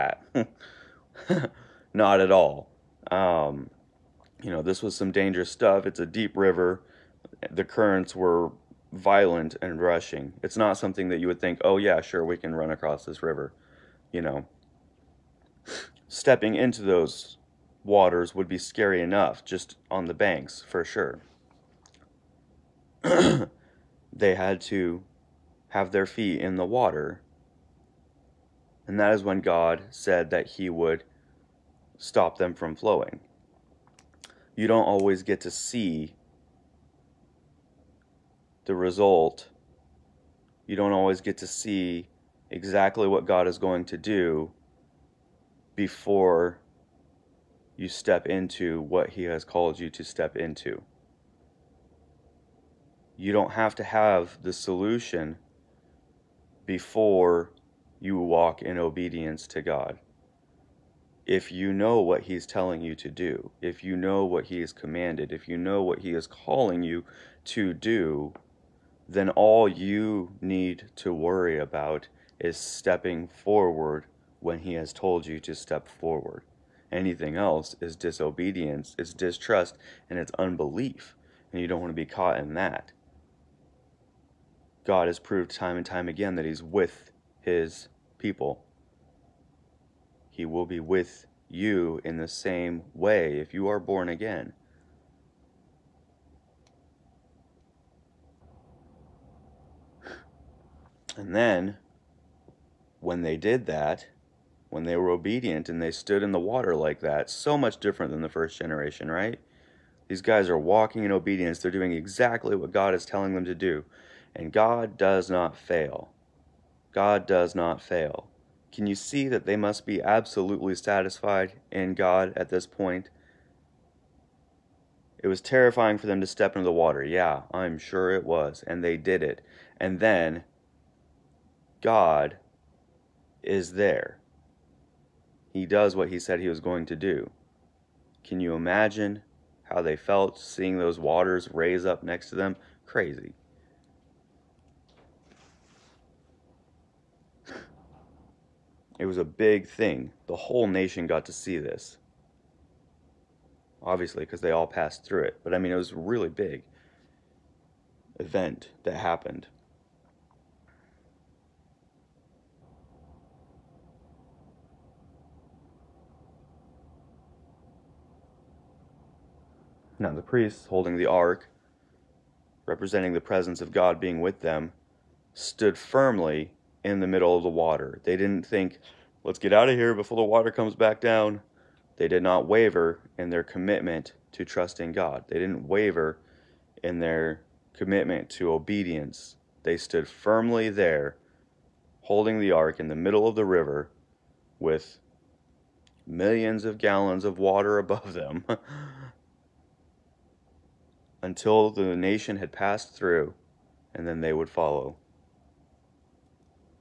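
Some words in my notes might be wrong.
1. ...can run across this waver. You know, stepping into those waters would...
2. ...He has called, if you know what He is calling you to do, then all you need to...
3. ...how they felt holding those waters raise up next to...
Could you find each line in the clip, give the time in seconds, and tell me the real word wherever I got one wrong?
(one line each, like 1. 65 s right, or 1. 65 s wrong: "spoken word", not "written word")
1. 12 s wrong: "river", not "waver"
2. 64 s wrong: "commanded", not "called"
3. 139 s wrong: "seeing", not "holding".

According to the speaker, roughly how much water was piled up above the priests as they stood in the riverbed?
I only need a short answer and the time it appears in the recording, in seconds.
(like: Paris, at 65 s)
millions of gallons, at 196 s.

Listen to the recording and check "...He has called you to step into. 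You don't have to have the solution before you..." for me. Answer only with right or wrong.
right.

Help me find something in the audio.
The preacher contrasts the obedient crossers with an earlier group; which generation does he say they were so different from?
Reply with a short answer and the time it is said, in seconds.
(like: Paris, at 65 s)
the first generation, at 108 s.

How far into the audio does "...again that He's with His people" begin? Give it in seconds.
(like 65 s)
86 s.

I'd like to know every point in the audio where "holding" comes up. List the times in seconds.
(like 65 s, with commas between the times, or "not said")
170 s, 192 s.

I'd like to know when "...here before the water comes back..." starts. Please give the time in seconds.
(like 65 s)
179 s.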